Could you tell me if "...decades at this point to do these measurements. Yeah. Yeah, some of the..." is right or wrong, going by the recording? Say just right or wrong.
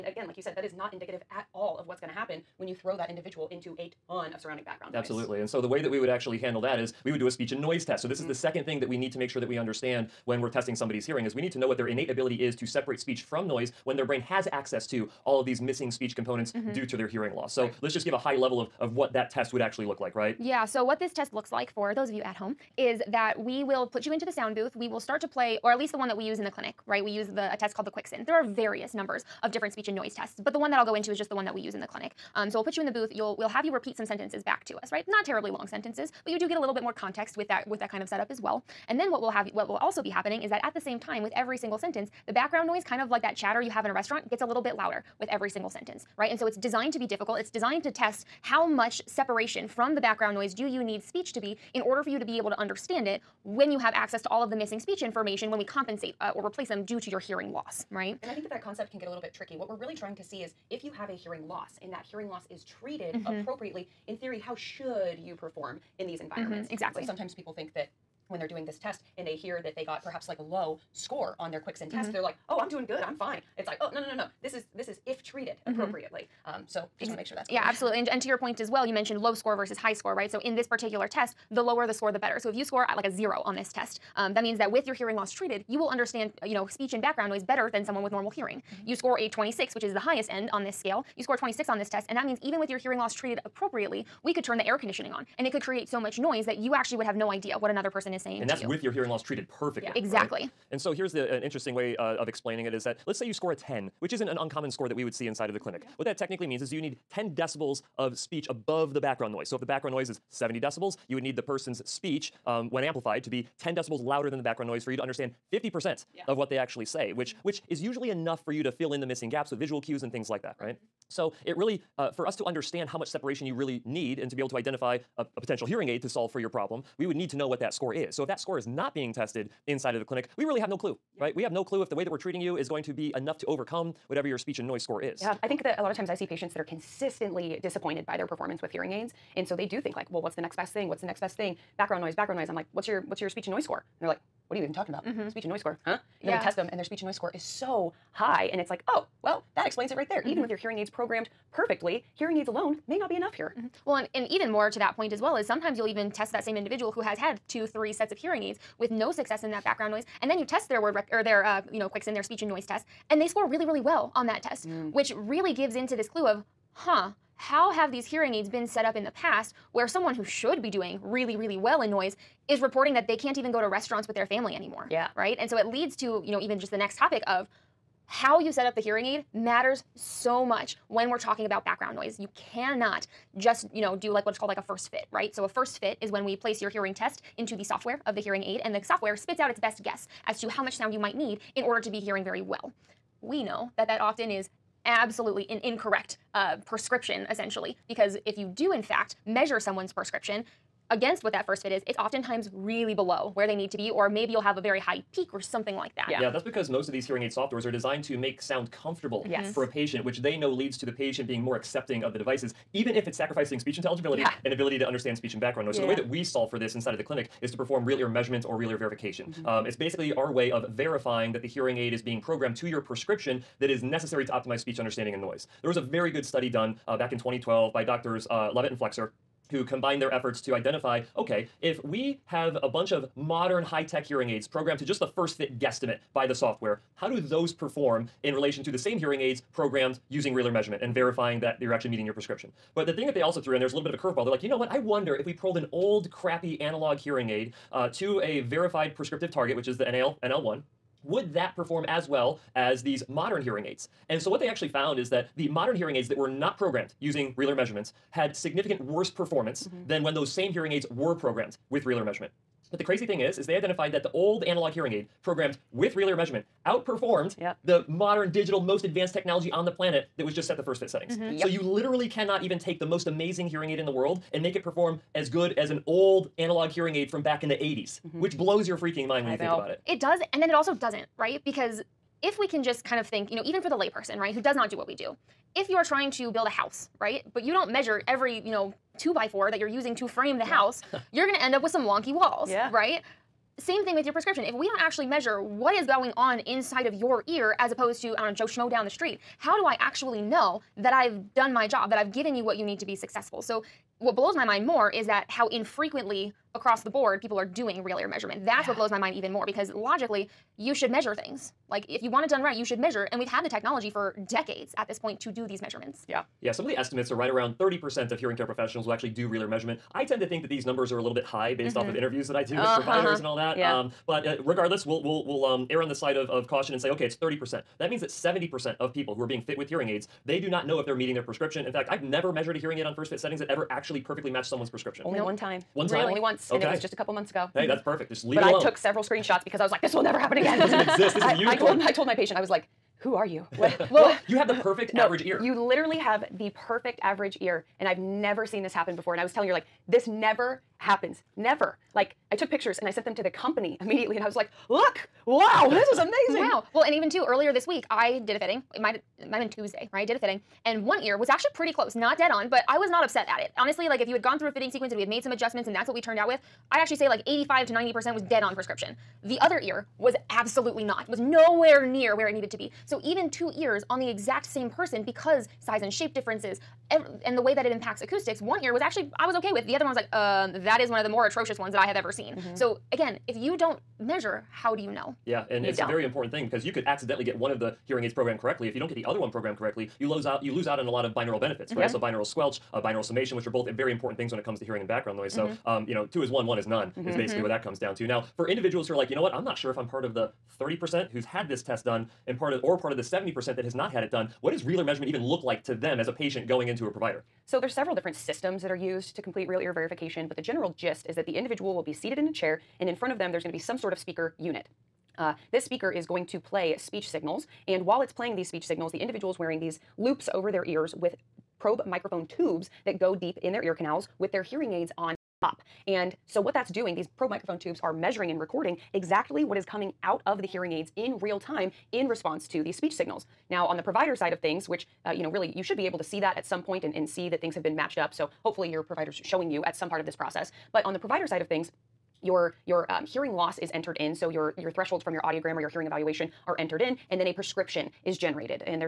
right.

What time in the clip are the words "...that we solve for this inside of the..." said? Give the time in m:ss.
3:35.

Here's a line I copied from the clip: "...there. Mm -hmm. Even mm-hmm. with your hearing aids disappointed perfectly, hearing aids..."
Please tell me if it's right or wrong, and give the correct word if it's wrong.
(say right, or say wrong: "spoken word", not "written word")
wrong: "programmed", not "disappointed".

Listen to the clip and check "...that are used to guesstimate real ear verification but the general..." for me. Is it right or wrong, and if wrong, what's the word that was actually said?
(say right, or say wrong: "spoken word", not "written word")
wrong: "complete", not "guesstimate".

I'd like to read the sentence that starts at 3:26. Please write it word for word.
Yeah, yeah that's because most of these hearing aid softwares are designed to make sound comfortable yes.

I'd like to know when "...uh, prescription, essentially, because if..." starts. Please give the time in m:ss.
3:16.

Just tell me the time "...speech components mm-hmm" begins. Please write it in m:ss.
0:15.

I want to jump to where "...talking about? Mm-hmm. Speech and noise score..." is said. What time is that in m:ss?
2:24.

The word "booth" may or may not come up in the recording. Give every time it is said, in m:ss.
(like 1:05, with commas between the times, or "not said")
0:24, 0:32.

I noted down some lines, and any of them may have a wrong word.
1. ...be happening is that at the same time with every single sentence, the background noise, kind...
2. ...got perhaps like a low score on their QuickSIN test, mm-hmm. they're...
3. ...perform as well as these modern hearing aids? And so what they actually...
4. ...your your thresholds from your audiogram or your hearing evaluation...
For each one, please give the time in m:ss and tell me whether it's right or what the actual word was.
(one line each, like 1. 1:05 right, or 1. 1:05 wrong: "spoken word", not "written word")
1. 0:40 right
2. 1:09 right
3. 4:11 right
4. 7:24 right.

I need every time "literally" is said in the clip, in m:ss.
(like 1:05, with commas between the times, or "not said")
4:31, 5:45.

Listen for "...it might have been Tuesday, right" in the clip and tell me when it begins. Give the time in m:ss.
5:59.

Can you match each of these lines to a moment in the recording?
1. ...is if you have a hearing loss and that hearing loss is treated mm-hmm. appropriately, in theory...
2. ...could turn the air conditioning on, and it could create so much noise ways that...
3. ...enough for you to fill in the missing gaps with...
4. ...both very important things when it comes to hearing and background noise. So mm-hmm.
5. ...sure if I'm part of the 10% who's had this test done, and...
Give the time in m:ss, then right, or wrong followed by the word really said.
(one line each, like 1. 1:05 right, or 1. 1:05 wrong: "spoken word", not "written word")
1. 1:00 right
2. 1:34 right
3. 1:58 right
4. 6:33 right
5. 6:39 wrong: "30", not "10".